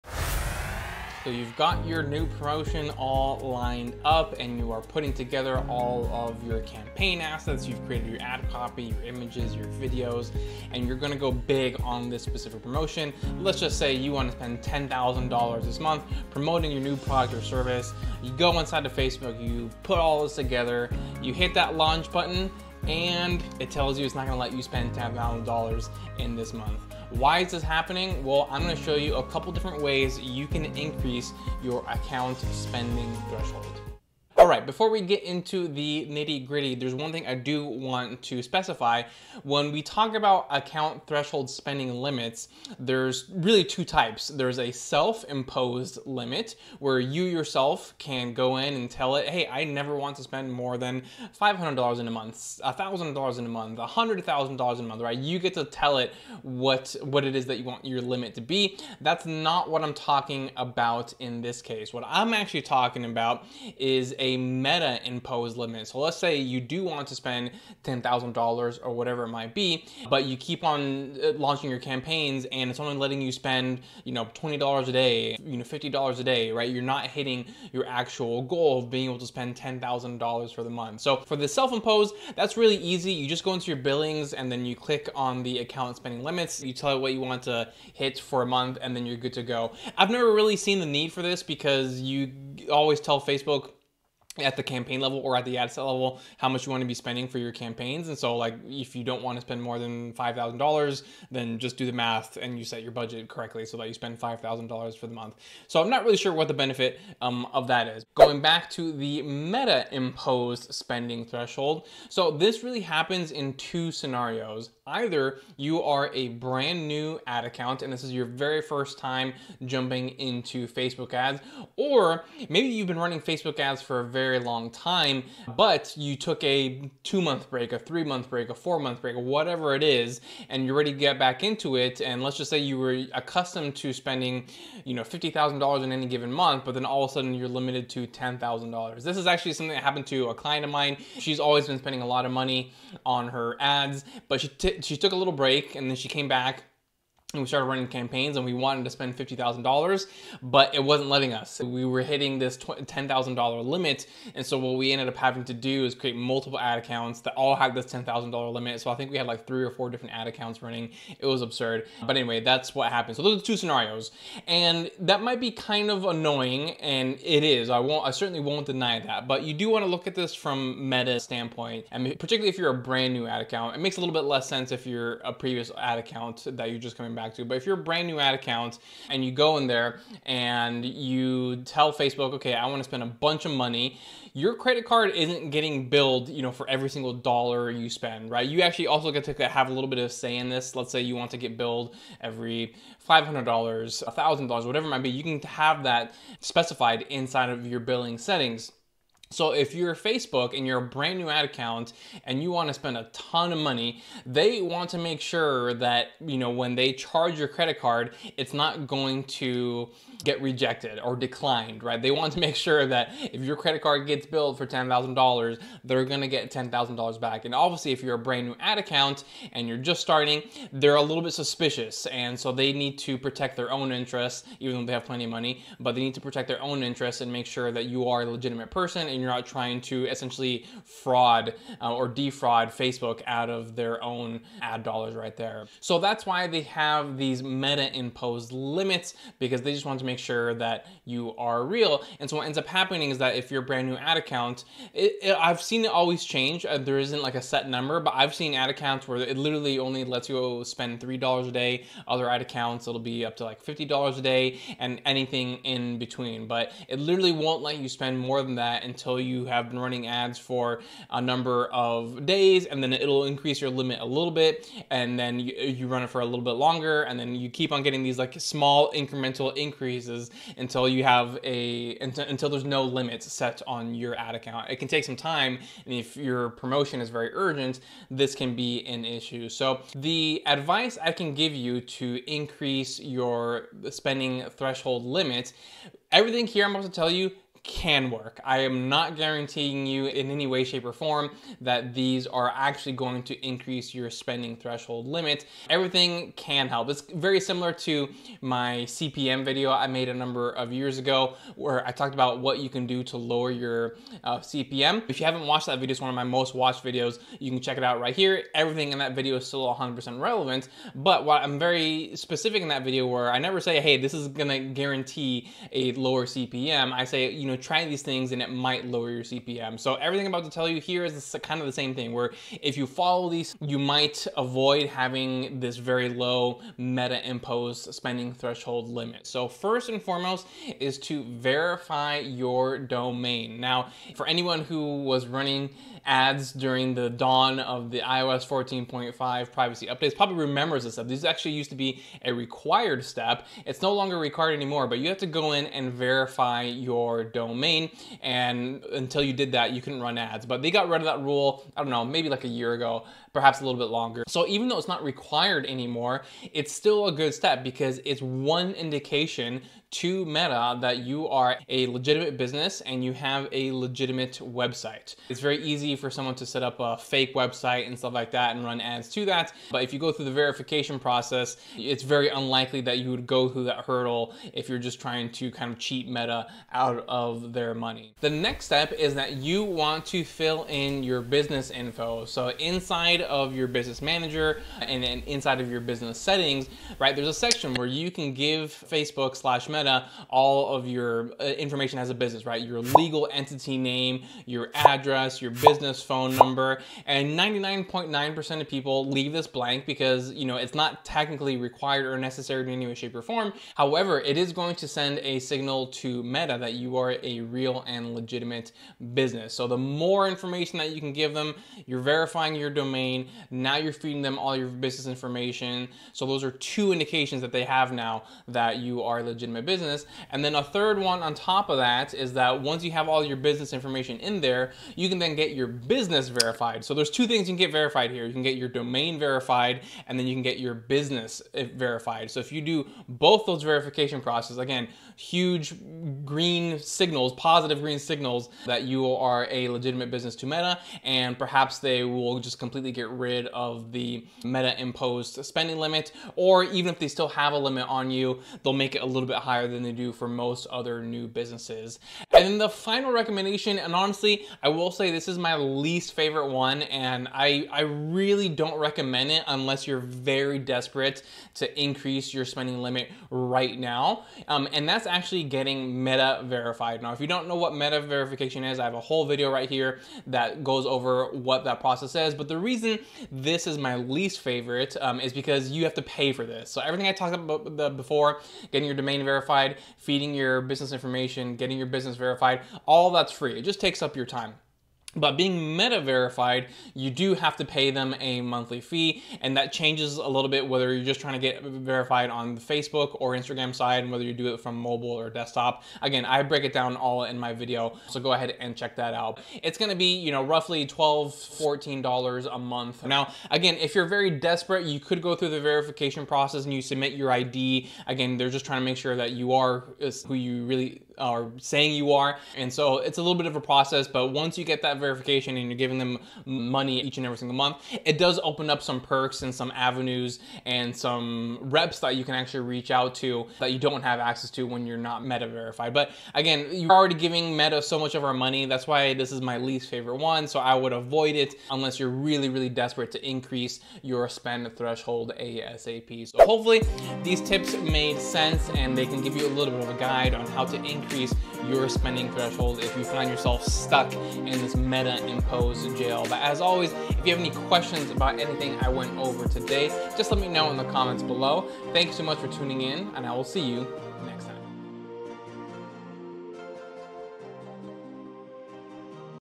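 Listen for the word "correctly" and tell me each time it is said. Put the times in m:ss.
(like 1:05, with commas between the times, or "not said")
1:43.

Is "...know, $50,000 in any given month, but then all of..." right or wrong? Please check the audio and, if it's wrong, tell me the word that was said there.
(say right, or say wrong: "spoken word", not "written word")
right.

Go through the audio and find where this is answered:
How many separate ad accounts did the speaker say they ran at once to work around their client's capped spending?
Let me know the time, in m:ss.
2:39.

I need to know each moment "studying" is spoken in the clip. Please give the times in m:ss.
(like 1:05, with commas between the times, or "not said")
not said.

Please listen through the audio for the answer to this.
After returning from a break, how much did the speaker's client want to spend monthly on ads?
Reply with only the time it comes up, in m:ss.
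2:28.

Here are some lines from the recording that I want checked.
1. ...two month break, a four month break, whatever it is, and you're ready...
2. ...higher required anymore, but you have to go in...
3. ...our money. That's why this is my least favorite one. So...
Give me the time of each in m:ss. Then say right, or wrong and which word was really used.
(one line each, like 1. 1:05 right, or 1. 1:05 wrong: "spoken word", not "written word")
1. 2:07 wrong: "three", not "two"
2. 5:43 wrong: "longer", not "higher"
3. 8:48 right.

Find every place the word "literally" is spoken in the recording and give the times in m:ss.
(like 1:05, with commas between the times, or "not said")
4:09, 4:16.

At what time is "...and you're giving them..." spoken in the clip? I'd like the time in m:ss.
8:35.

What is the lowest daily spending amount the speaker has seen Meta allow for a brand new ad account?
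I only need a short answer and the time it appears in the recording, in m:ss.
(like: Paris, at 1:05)
$3 a day, at 4:10.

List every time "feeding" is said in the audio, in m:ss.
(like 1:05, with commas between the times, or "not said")
6:53, 7:59.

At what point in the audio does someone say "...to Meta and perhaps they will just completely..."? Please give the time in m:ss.
7:20.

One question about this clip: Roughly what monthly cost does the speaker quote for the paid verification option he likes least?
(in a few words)
$12 to $14.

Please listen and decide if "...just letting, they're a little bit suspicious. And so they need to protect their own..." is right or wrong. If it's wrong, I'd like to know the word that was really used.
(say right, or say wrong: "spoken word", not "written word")
wrong: "starting", not "letting".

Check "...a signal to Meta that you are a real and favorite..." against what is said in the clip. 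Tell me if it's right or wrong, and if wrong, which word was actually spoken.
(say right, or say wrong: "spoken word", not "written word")
wrong: "legitimate", not "favorite".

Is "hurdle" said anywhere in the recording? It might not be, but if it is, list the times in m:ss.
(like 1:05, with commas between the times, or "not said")
6:13.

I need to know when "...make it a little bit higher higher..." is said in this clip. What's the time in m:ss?
7:28.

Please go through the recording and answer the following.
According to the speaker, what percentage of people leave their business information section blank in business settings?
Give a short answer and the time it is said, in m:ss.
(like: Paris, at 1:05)
99.9%, at 6:37.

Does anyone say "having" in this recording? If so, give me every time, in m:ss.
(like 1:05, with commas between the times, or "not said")
2:35, 5:24.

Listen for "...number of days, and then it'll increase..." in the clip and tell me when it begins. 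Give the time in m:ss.
4:21.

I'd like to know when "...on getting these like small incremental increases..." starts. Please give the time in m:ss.
4:27.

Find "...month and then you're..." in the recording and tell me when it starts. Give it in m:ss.
1:28.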